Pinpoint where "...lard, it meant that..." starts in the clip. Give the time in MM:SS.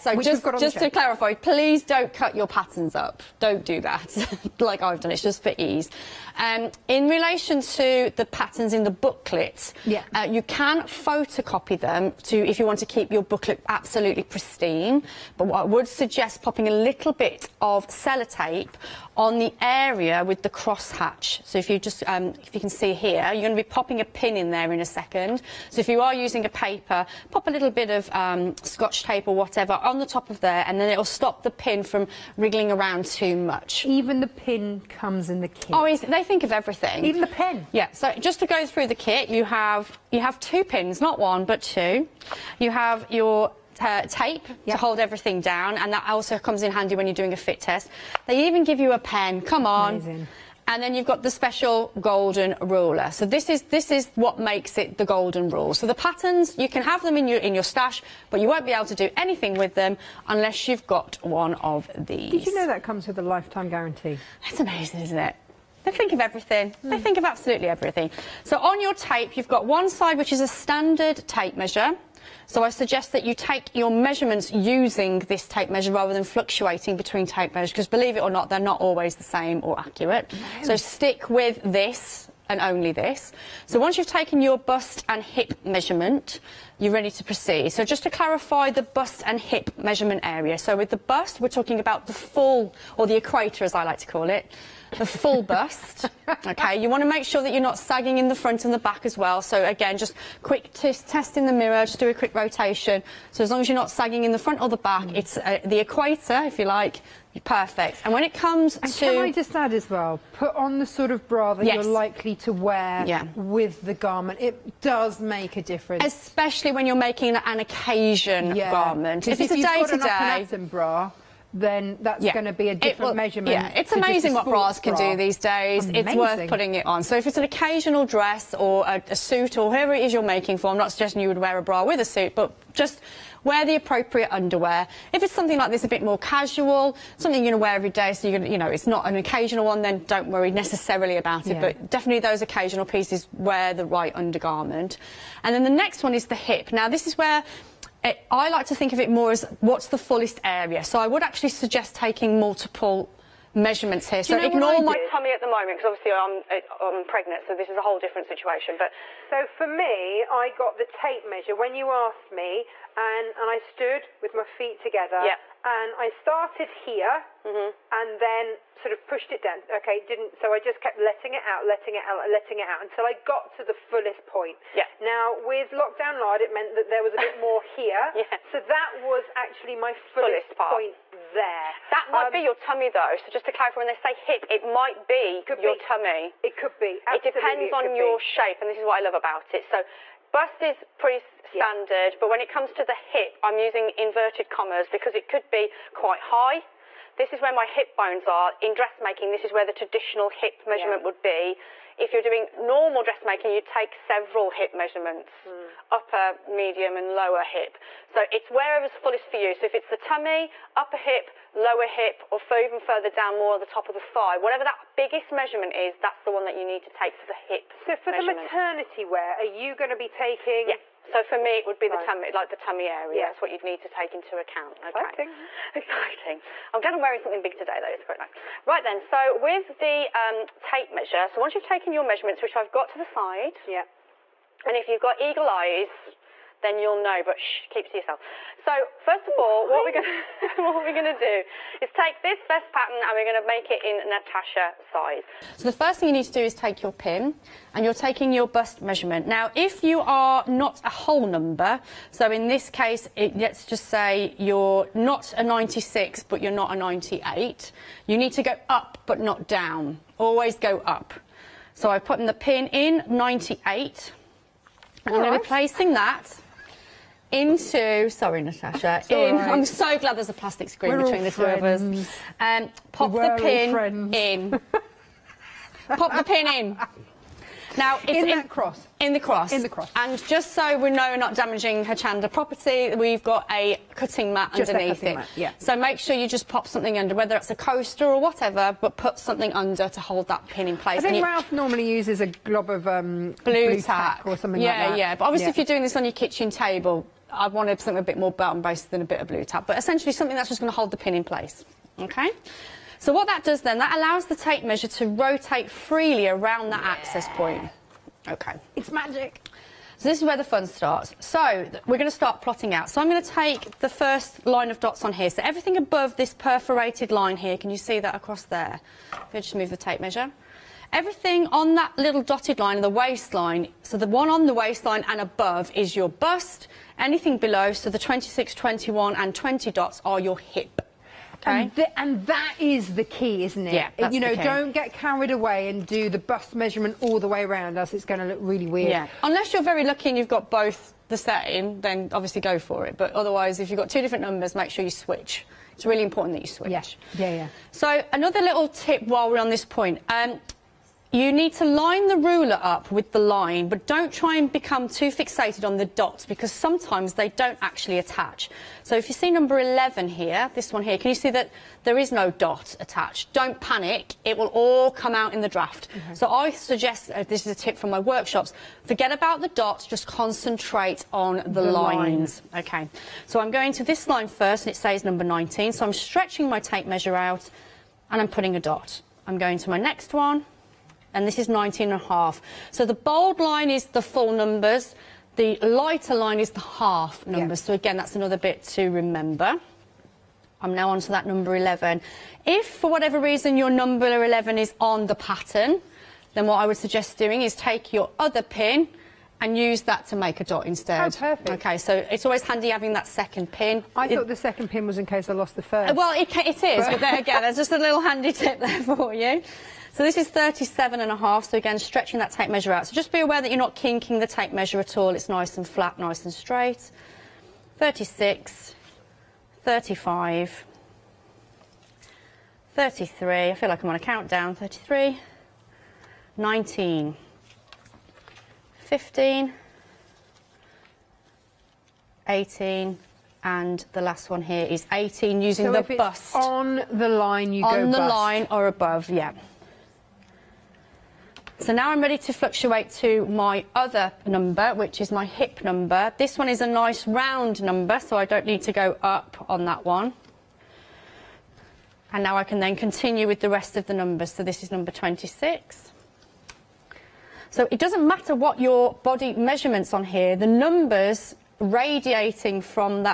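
02:56.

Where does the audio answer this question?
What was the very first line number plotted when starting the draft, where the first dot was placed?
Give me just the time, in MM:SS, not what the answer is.
06:15.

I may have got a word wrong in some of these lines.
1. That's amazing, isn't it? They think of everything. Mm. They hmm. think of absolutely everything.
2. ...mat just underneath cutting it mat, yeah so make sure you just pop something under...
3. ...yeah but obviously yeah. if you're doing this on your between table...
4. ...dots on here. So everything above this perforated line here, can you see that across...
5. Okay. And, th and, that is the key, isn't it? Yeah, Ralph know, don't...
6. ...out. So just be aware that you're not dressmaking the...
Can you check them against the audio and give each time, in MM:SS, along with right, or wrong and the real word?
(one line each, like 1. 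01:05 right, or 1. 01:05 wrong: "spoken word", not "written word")
1. 01:04 right
2. 04:44 right
3. 04:55 wrong: "kitchen", not "between"
4. 05:14 right
5. 05:31 wrong: "You", not "Ralph"
6. 06:52 wrong: "kinking", not "dressmaking".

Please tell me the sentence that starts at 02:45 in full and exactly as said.
Yeah and I started here mm-hmm.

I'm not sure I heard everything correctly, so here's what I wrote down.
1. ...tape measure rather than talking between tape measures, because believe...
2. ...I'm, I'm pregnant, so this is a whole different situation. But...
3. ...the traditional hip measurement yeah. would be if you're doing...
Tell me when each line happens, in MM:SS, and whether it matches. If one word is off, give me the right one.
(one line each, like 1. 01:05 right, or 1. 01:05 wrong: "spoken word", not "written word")
1. 01:15 wrong: "fluctuating", not "talking"
2. 02:36 right
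3. 03:19 right.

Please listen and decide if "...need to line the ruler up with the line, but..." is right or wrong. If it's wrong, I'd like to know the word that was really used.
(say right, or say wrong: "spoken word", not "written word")
right.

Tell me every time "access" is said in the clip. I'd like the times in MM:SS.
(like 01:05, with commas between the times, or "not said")
05:06.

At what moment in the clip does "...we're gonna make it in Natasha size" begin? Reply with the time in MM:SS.
04:03.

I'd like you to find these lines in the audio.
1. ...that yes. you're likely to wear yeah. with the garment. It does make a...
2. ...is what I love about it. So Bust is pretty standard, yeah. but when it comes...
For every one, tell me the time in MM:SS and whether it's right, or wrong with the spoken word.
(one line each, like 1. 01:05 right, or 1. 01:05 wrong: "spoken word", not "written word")
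1. 01:51 right
2. 03:08 right.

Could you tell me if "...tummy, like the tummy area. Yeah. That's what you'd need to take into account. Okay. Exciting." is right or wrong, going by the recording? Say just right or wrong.
right.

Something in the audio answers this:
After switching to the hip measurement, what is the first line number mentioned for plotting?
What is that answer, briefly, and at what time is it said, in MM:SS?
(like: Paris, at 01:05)
26, at 07:34.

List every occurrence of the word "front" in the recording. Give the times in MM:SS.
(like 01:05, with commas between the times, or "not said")
01:38, 01:44.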